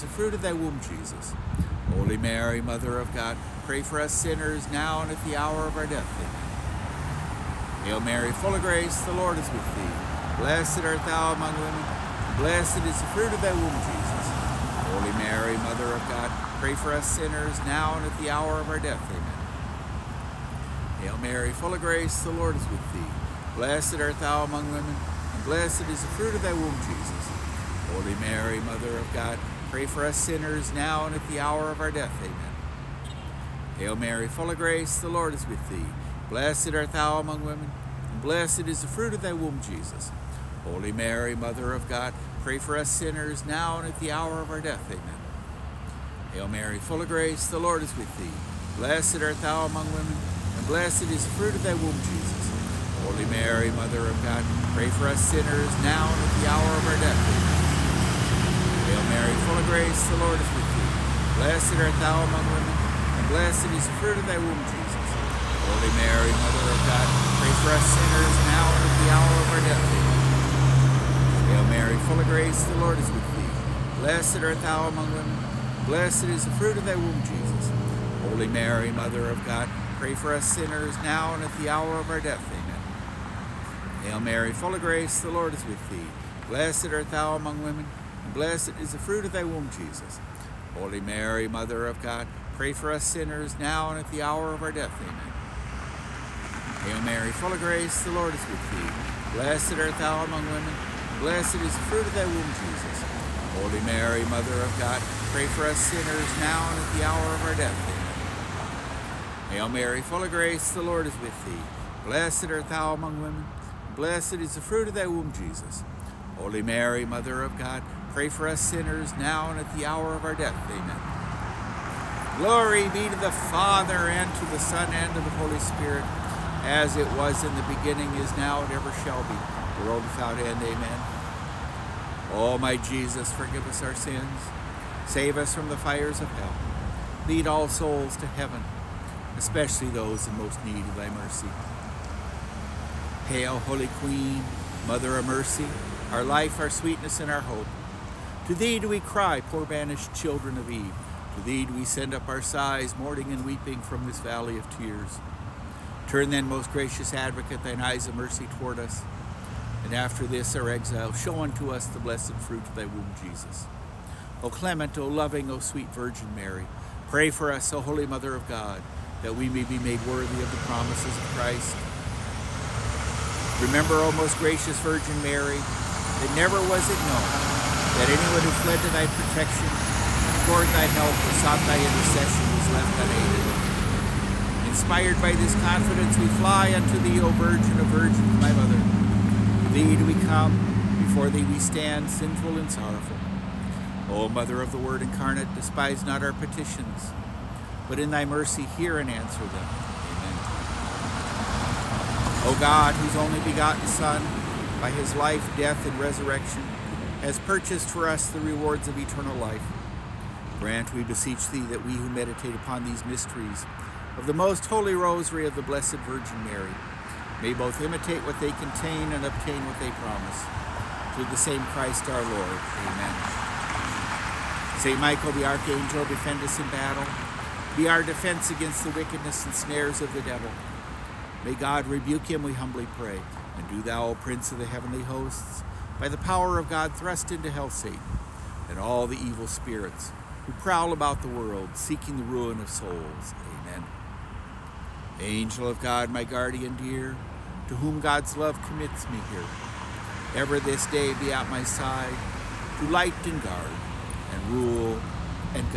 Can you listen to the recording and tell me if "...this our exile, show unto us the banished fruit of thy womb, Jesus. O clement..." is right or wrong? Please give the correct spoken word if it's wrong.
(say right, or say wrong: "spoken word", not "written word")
wrong: "blessed", not "banished".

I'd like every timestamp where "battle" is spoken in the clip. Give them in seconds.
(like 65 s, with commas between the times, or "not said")
226 s.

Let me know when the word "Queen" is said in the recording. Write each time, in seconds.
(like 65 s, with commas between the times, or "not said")
143 s.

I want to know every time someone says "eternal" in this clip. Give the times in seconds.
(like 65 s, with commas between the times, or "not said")
208 s.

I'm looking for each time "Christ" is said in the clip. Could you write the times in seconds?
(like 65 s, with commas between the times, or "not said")
171 s, 221 s.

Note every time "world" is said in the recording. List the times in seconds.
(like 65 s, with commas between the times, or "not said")
129 s, 241 s.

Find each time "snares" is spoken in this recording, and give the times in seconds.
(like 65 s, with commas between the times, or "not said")
229 s.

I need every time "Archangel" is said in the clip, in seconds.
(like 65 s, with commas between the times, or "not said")
225 s.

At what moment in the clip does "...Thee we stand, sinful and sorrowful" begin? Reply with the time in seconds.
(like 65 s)
191 s.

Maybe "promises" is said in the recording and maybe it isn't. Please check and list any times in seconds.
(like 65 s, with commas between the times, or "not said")
170 s, 219 s.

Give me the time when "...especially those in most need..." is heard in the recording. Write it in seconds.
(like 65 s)
139 s.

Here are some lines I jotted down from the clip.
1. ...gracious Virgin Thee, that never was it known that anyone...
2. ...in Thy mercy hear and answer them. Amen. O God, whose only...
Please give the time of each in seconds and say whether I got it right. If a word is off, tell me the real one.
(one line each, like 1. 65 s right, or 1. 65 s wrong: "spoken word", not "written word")
1. 174 s wrong: "Mary", not "Thee"
2. 197 s right.